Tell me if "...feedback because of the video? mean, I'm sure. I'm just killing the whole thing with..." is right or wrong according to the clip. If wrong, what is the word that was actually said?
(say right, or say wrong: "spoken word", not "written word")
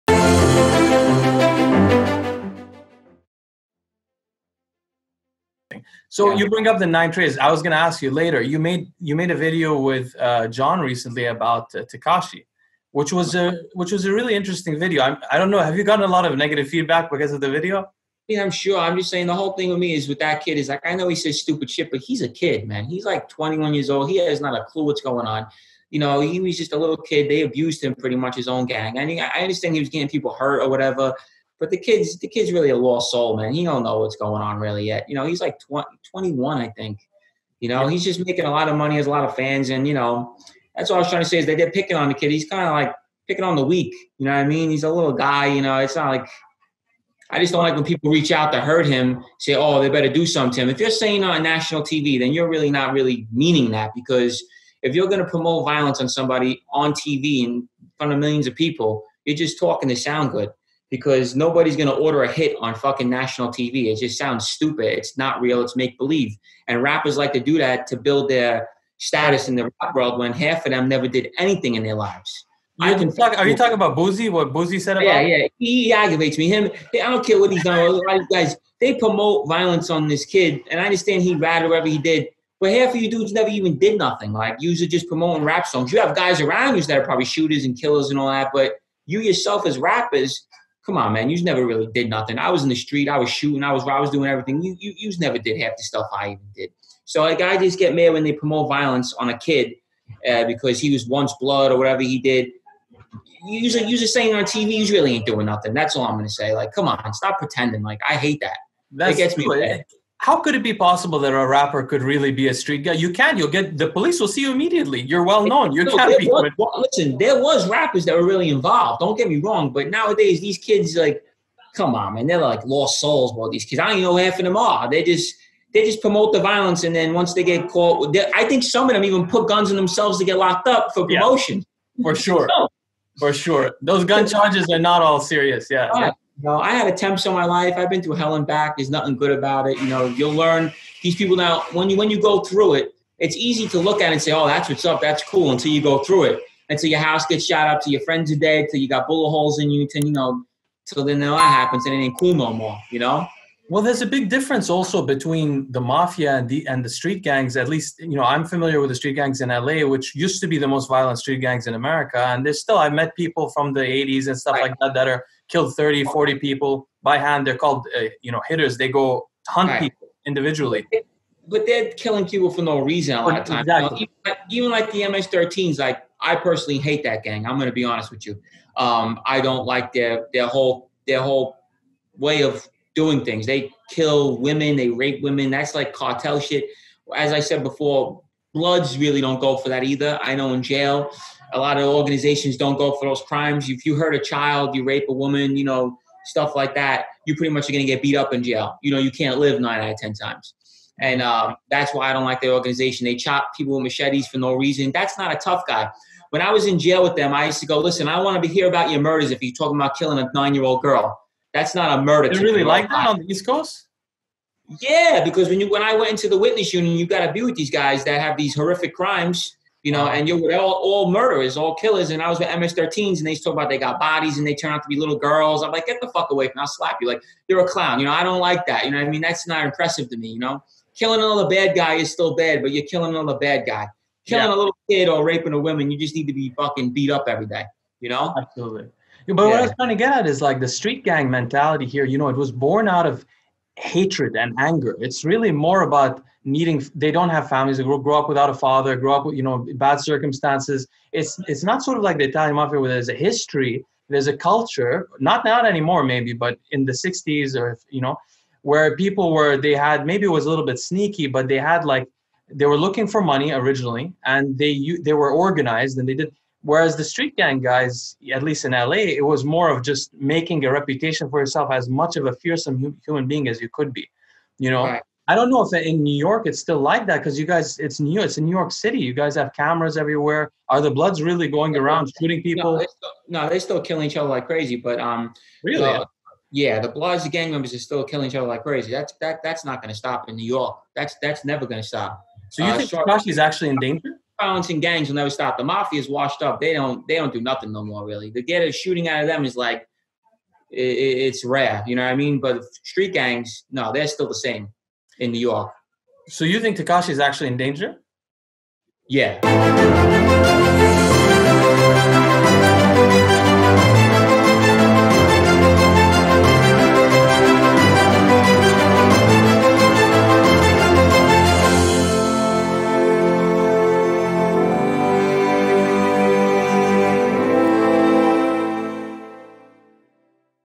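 wrong: "saying", not "killing".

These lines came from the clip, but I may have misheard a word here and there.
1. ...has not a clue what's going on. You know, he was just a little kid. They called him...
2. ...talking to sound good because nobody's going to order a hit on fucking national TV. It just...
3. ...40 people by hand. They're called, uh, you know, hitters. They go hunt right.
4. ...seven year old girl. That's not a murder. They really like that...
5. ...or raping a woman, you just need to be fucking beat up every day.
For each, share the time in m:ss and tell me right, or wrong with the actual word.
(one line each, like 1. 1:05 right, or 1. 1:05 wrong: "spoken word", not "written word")
1. 0:24 wrong: "abused", not "called"
2. 0:59 right
3. 2:46 right
4. 3:30 wrong: "nine", not "seven"
5. 3:55 right.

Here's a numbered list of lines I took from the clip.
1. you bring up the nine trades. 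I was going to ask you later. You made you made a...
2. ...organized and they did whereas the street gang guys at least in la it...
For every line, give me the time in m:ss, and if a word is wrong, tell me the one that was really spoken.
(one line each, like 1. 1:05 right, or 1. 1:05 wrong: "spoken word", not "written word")
1. 0:06 right
2. 4:25 right.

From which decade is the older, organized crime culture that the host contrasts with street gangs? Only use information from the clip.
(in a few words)
the 60s.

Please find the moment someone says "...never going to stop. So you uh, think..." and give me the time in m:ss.
4:51.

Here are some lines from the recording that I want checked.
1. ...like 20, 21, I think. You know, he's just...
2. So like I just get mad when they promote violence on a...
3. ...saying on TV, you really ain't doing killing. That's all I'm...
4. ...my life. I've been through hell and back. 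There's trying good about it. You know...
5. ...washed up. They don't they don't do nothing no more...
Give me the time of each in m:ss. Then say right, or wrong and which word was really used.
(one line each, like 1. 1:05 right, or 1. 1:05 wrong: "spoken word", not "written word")
1. 0:35 right
2. 1:37 right
3. 1:44 wrong: "nothing", not "killing"
4. 2:17 wrong: "nothing", not "trying"
5. 4:56 right.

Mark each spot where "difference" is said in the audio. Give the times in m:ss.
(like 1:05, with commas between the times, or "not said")
2:34.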